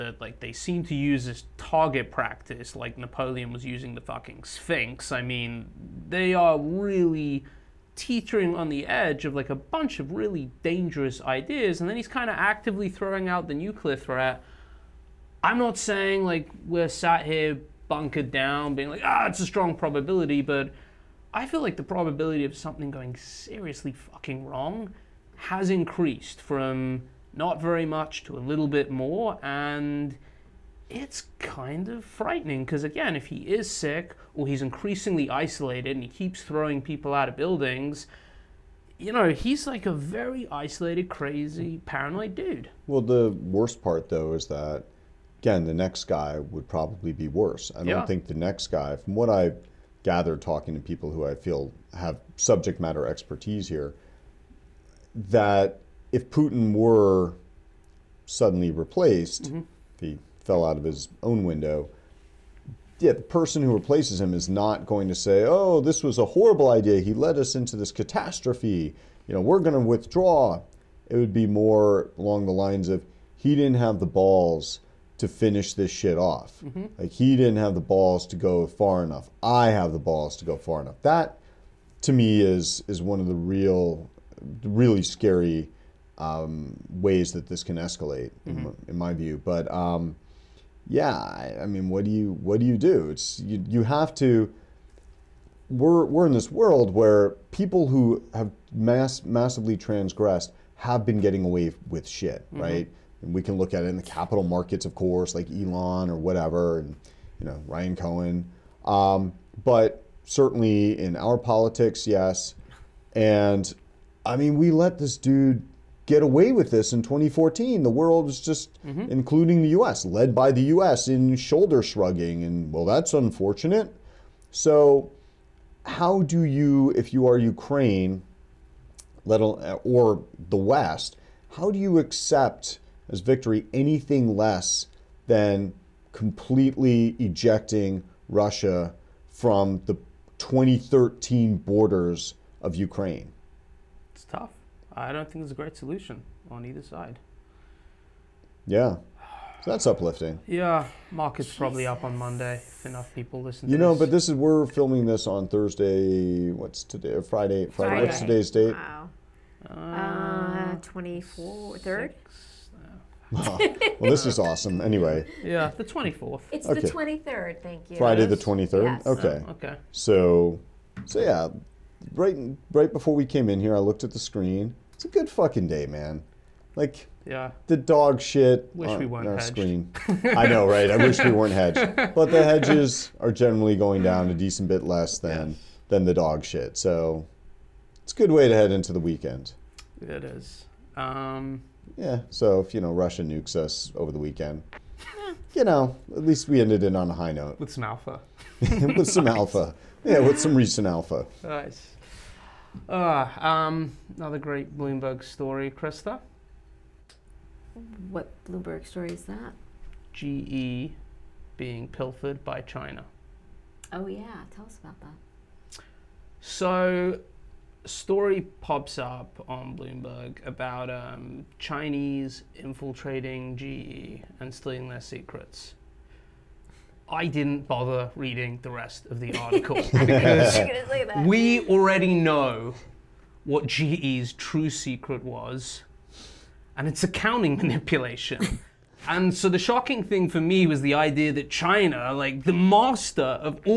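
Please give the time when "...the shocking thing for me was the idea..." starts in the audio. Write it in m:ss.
3:59.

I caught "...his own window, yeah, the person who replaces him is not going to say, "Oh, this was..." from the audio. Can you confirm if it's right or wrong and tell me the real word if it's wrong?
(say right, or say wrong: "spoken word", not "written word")
right.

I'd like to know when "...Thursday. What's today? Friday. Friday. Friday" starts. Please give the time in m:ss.
2:35.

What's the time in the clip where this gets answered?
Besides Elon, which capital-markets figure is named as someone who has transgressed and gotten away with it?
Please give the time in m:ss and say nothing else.
1:47.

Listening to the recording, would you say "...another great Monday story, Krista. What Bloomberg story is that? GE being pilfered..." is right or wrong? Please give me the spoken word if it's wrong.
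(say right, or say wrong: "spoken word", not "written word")
wrong: "Bloomberg", not "Monday".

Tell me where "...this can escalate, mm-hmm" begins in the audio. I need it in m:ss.
1:27.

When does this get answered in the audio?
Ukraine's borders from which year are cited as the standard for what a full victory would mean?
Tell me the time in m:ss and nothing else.
2:20.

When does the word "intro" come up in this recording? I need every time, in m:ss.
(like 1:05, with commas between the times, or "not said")
not said.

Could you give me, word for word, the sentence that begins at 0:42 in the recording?
Well, the worst part, though, is that, again, the next guy would probably be worse.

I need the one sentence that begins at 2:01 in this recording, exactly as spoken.
in shoulder shrugging, and well, that's unfortunate.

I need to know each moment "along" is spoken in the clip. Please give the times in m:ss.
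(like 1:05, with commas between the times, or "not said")
1:12.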